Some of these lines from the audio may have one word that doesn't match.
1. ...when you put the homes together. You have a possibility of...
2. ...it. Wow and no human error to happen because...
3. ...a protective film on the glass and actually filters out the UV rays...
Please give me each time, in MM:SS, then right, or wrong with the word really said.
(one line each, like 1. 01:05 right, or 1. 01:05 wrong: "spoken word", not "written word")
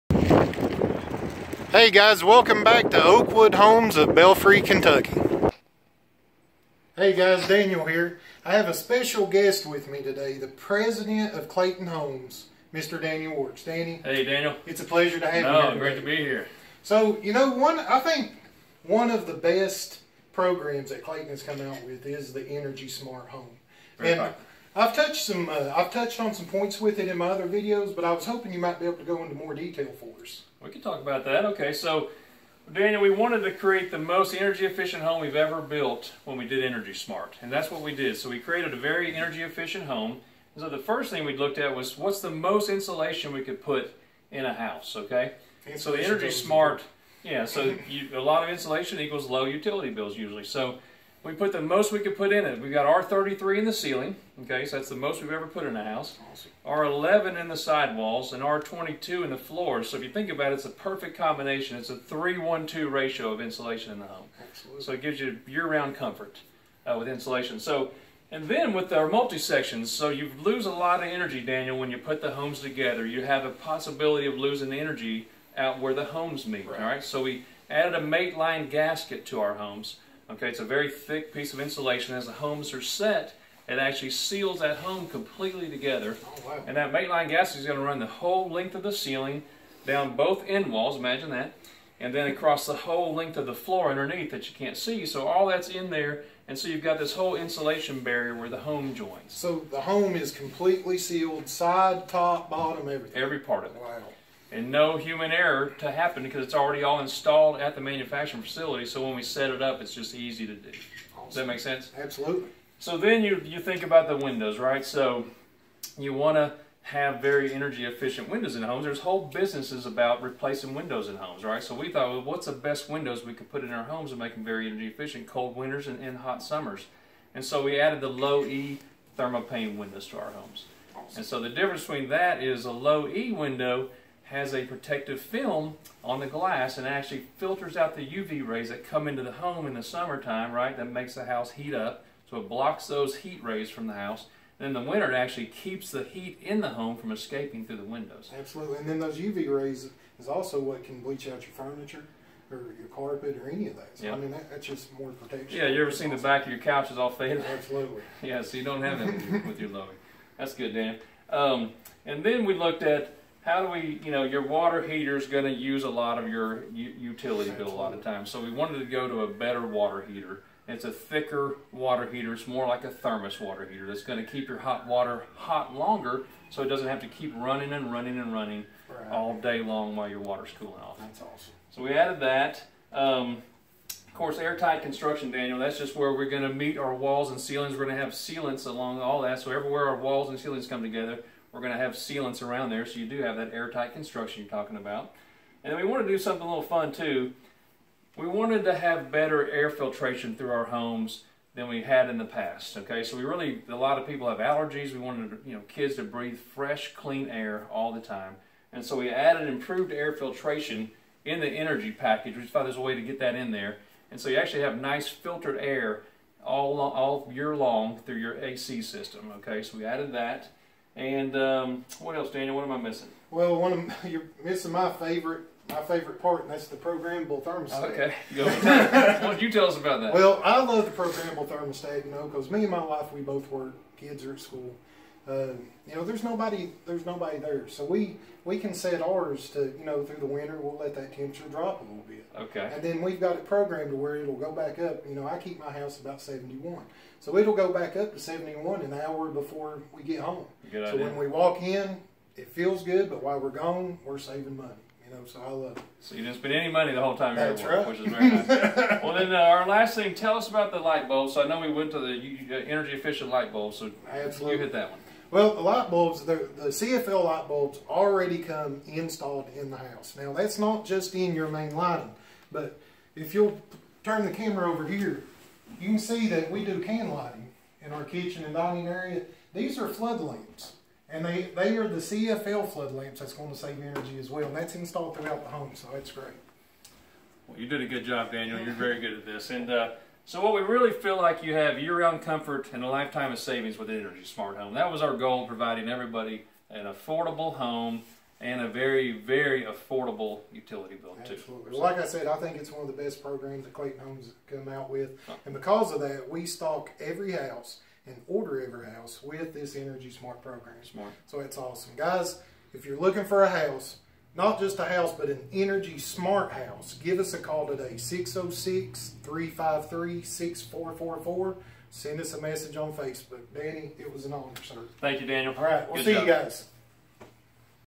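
1. 01:11 right
2. 01:43 right
3. 02:14 right.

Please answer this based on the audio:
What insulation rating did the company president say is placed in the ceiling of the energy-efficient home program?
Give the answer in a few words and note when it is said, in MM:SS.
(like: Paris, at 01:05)
R33, at 00:52.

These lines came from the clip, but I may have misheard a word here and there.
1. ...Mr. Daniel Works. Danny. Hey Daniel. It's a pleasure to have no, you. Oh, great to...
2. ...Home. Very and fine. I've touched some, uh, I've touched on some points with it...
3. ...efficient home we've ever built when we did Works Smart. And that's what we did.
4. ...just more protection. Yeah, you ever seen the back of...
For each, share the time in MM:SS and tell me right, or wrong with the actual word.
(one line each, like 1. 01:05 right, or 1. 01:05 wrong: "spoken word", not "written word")
1. 00:12 right
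2. 00:23 right
3. 00:34 wrong: "Energy", not "Works"
4. 02:34 right.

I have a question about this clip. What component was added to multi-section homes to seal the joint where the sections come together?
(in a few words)
mate line gasket.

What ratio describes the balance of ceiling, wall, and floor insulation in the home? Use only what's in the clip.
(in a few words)
3-1-2.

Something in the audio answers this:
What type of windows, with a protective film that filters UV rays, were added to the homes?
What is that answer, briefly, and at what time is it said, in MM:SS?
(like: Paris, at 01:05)
low E thermopane windows, at 02:08.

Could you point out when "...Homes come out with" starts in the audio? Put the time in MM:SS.
05:03.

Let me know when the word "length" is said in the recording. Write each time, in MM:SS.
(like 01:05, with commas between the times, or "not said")
01:28, 01:33.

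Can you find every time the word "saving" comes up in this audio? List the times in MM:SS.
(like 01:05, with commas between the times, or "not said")
04:14, 04:53.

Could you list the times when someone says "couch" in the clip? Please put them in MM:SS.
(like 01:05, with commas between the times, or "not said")
02:36.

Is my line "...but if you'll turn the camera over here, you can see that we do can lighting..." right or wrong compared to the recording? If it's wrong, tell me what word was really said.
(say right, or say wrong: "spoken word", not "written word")
right.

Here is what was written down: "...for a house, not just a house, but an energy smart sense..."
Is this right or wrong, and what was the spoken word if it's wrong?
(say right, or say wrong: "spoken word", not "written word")
wrong: "house", not "sense".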